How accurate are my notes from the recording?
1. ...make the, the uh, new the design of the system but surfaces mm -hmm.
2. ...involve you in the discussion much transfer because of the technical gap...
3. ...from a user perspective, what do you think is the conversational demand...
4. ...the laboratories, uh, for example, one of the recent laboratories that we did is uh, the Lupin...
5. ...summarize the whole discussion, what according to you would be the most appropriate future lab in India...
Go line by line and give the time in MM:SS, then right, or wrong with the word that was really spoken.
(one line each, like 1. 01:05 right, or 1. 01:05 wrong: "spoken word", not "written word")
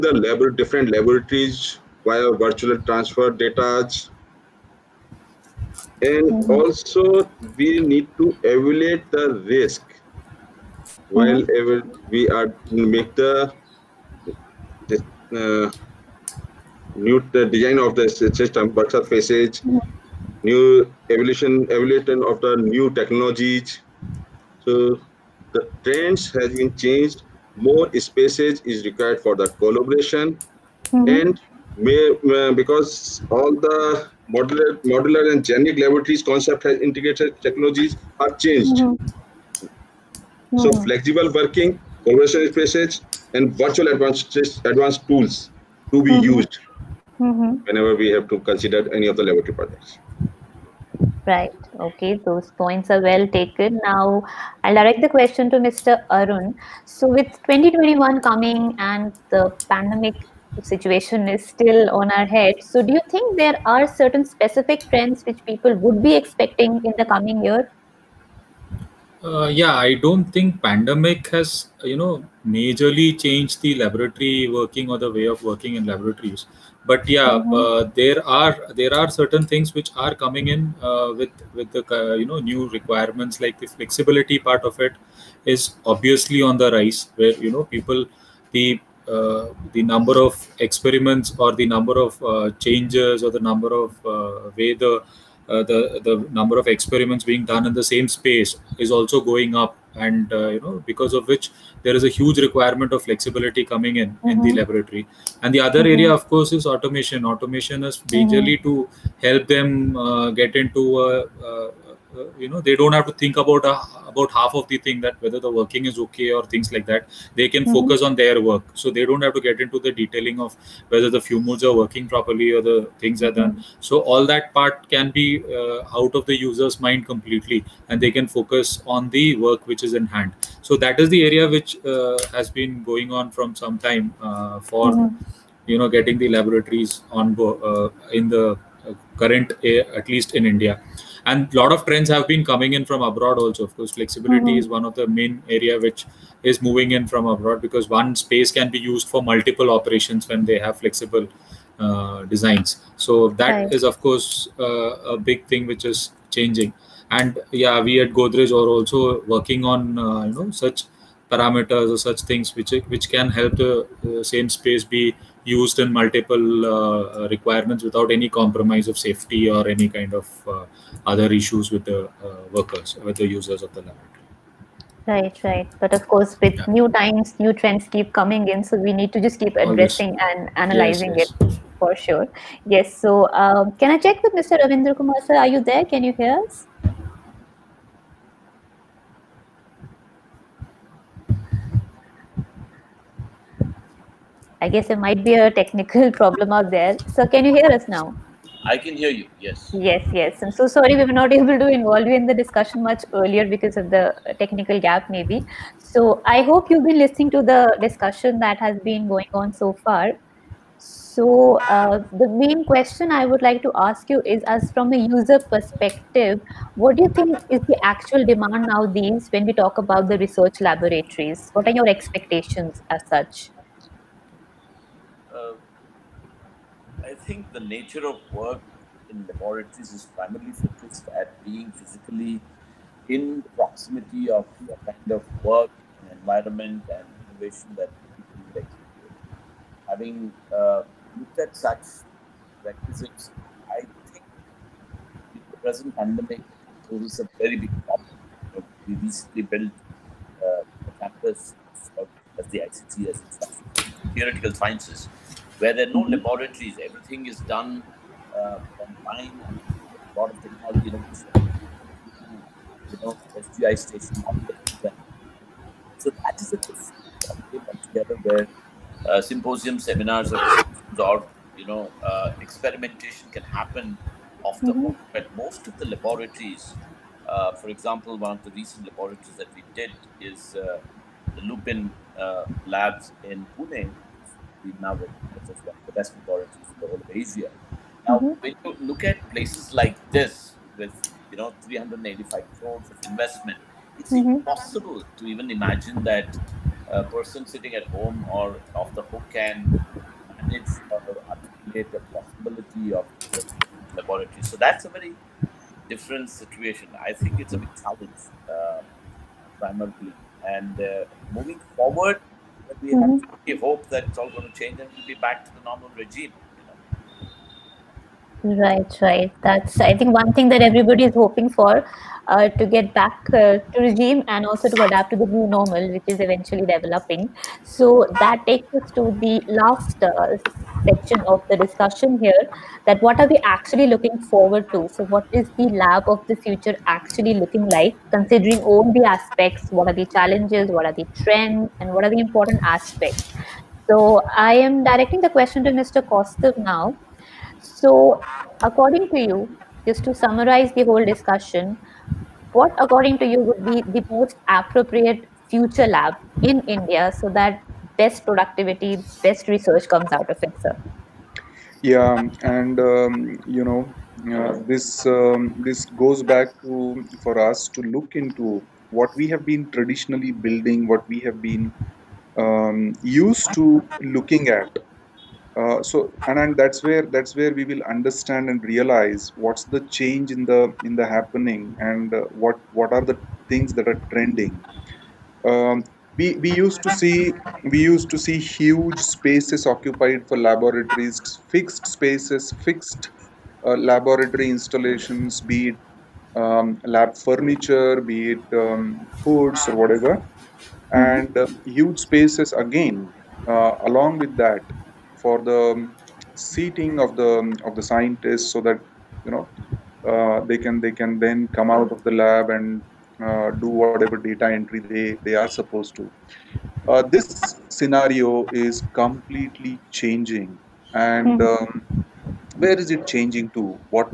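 1. 00:12 right
2. 03:21 wrong: "earlier", not "transfer"
3. 03:34 wrong: "actual", not "conversational"
4. 04:35 right
5. 05:50 right.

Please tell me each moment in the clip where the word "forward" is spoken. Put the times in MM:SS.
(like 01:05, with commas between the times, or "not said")
05:11, 05:34.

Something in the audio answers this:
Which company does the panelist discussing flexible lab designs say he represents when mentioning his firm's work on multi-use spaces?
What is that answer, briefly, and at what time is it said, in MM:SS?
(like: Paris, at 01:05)
Godrej, at 02:38.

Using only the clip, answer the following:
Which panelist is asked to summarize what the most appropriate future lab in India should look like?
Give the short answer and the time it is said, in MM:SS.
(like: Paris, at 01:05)
Kaustubh, at 05:46.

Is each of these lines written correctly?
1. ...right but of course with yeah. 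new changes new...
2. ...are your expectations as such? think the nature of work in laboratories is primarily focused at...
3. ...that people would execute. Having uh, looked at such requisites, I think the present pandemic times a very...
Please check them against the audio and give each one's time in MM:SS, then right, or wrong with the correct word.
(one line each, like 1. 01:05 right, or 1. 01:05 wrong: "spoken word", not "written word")
1. 02:55 wrong: "times", not "changes"
2. 03:41 right
3. 03:57 wrong: "poses", not "times".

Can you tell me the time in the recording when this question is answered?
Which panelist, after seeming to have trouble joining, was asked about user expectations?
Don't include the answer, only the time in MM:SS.
03:04.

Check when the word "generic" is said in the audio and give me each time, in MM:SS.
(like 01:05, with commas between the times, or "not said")
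00:35.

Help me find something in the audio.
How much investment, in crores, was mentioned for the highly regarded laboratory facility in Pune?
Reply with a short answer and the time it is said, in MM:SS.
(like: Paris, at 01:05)
385 crores, at 04:51.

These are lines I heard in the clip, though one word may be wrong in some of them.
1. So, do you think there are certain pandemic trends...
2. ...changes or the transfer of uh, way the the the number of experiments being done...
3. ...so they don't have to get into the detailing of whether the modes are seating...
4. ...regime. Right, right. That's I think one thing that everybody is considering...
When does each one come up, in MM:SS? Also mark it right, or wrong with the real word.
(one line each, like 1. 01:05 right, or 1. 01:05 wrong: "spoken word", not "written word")
1. 01:02 wrong: "specific", not "pandemic"
2. 01:32 wrong: "number", not "transfer"
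3. 01:58 wrong: "working", not "seating"
4. 05:15 wrong: "hoping", not "considering".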